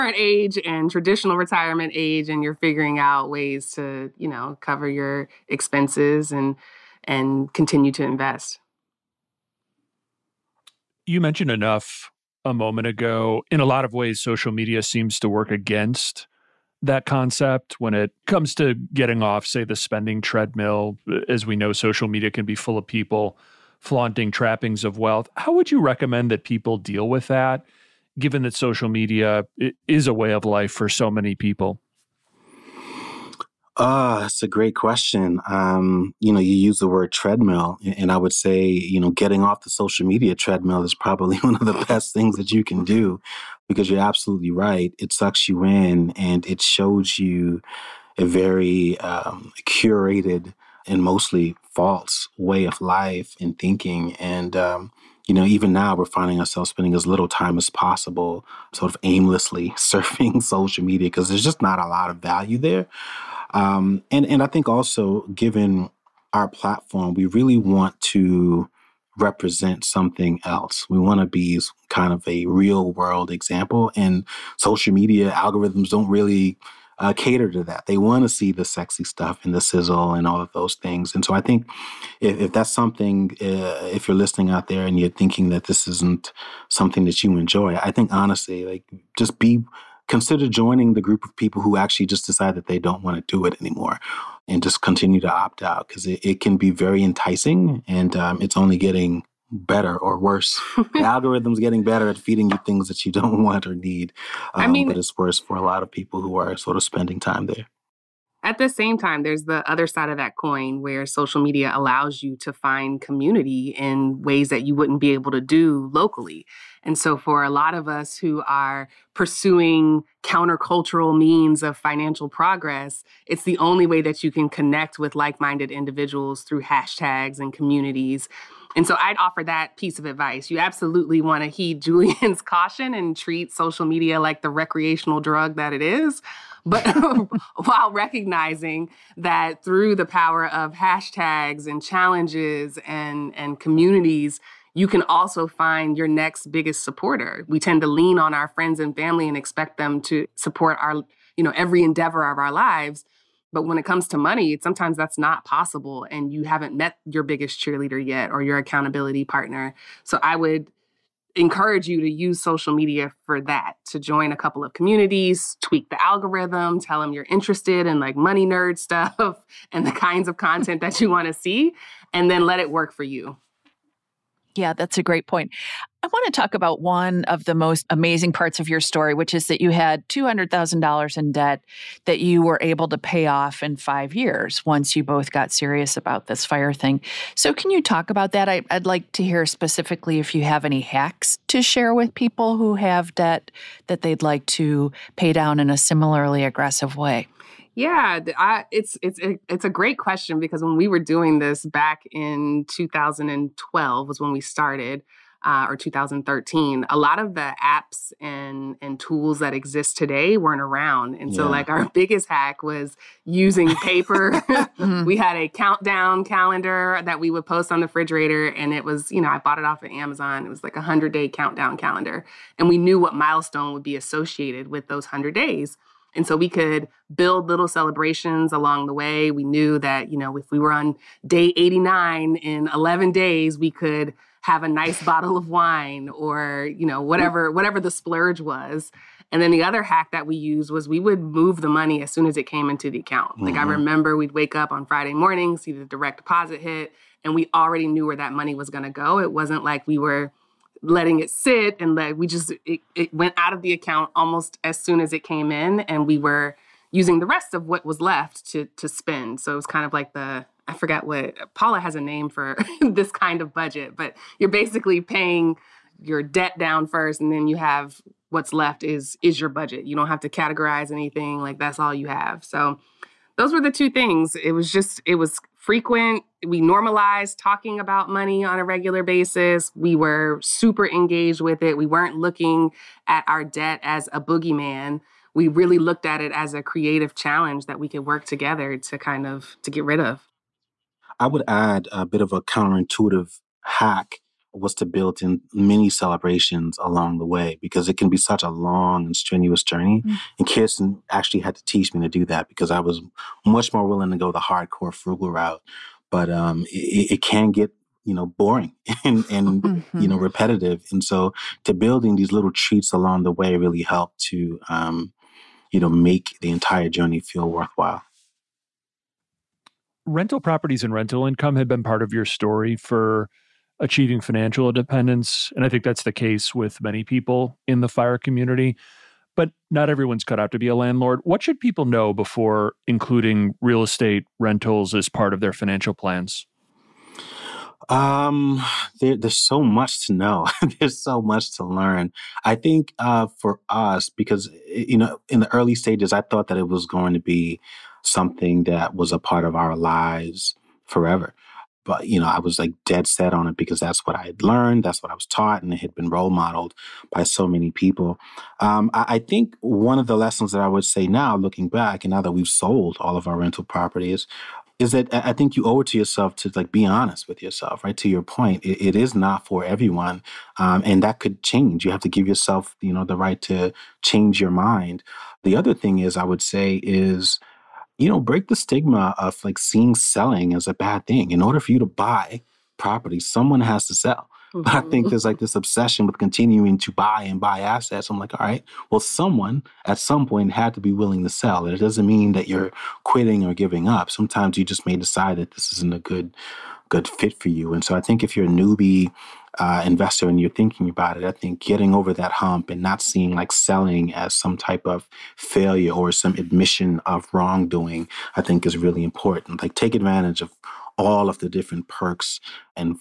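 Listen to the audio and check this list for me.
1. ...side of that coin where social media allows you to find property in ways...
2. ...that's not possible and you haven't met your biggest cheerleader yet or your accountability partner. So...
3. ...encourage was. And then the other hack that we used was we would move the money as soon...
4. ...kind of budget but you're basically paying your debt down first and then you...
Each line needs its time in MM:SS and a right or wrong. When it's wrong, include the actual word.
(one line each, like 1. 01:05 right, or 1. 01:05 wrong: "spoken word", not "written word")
1. 01:49 wrong: "community", not "property"
2. 02:34 right
3. 03:57 wrong: "splurge", not "encourage"
4. 04:23 right.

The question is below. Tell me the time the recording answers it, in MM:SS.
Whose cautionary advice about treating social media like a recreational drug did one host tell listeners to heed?
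02:11.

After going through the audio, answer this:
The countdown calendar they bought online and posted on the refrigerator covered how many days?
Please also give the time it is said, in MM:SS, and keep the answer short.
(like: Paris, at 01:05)
100, at 03:40.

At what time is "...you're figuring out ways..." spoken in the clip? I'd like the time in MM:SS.
00:02.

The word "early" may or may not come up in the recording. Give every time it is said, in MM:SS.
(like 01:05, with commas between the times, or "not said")
05:45.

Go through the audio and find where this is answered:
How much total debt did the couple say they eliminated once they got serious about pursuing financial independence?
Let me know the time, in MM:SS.
03:00.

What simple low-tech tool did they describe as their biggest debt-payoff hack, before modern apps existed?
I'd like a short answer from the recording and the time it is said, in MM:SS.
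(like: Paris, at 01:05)
Paper, at 03:33.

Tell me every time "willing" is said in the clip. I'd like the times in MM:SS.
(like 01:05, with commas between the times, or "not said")
05:03, 06:30.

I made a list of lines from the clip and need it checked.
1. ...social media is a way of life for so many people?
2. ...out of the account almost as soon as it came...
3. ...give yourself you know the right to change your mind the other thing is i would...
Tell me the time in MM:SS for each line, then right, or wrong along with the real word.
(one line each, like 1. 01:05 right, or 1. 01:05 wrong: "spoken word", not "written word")
1. 00:28 right
2. 04:13 right
3. 06:12 right.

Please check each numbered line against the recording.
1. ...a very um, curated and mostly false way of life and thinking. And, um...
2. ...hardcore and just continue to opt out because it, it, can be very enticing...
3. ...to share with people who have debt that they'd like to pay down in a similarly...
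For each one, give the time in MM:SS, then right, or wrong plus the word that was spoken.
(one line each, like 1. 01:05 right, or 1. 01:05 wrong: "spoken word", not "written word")
1. 00:48 right
2. 01:33 wrong: "anymore", not "hardcore"
3. 03:11 right.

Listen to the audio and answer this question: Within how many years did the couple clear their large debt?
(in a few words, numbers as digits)
5 years.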